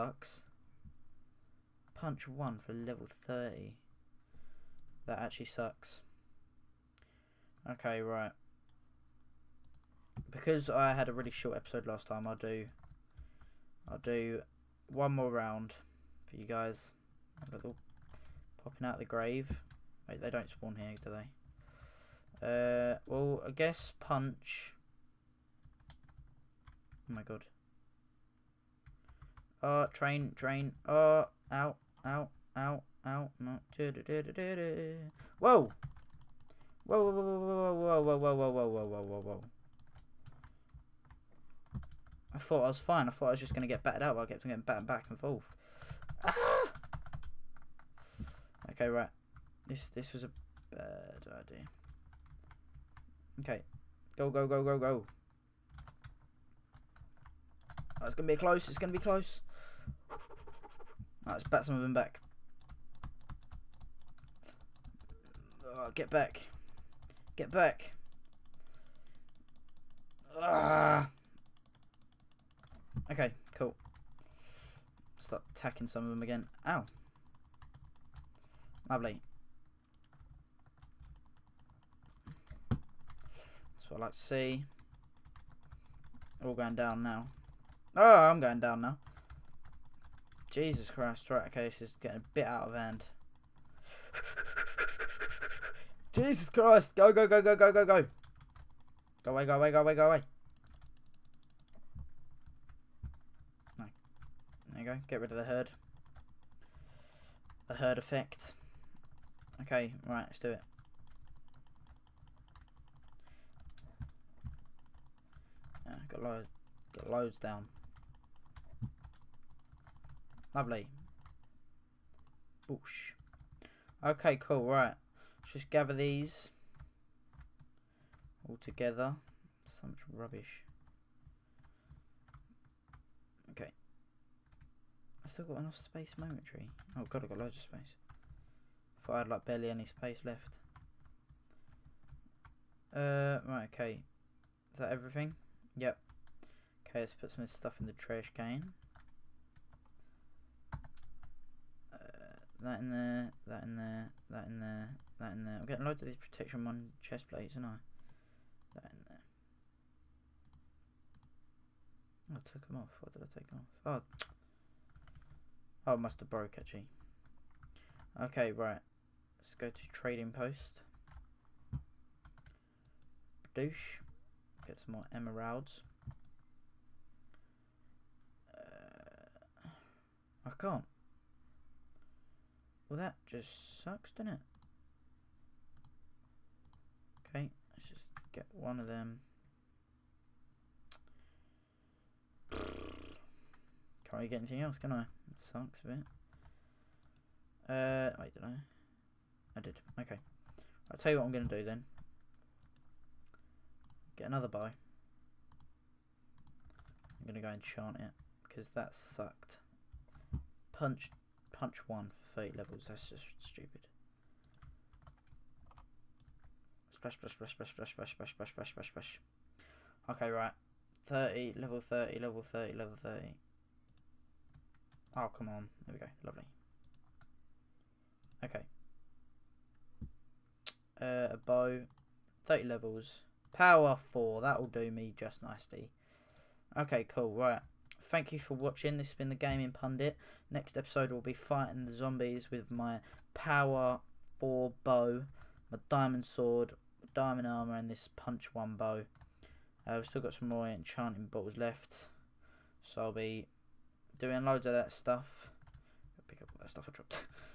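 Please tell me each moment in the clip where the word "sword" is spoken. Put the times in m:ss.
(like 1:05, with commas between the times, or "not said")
4:06.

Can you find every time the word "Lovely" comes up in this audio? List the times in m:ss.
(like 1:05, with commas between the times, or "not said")
1:18, 2:00, 3:46.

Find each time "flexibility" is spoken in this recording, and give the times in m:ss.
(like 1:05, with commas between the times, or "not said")
not said.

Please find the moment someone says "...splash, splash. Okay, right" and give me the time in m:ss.
3:38.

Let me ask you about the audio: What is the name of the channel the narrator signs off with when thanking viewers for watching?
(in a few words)
The Gaming Pundit.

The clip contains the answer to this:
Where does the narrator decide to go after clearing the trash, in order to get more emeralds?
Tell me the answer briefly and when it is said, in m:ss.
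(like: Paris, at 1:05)
Trading post, at 2:49.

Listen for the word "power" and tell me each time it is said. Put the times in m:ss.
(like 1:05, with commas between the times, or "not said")
3:53, 4:03.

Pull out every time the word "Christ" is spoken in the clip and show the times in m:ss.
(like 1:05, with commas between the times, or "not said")
1:30, 1:36.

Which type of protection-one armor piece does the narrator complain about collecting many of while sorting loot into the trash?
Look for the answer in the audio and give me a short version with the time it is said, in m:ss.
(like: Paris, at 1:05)
Chest plates, at 2:37.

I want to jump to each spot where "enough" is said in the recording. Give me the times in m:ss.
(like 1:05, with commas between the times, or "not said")
2:15.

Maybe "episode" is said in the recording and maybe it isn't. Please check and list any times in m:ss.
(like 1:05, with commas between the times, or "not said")
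0:11, 4:00.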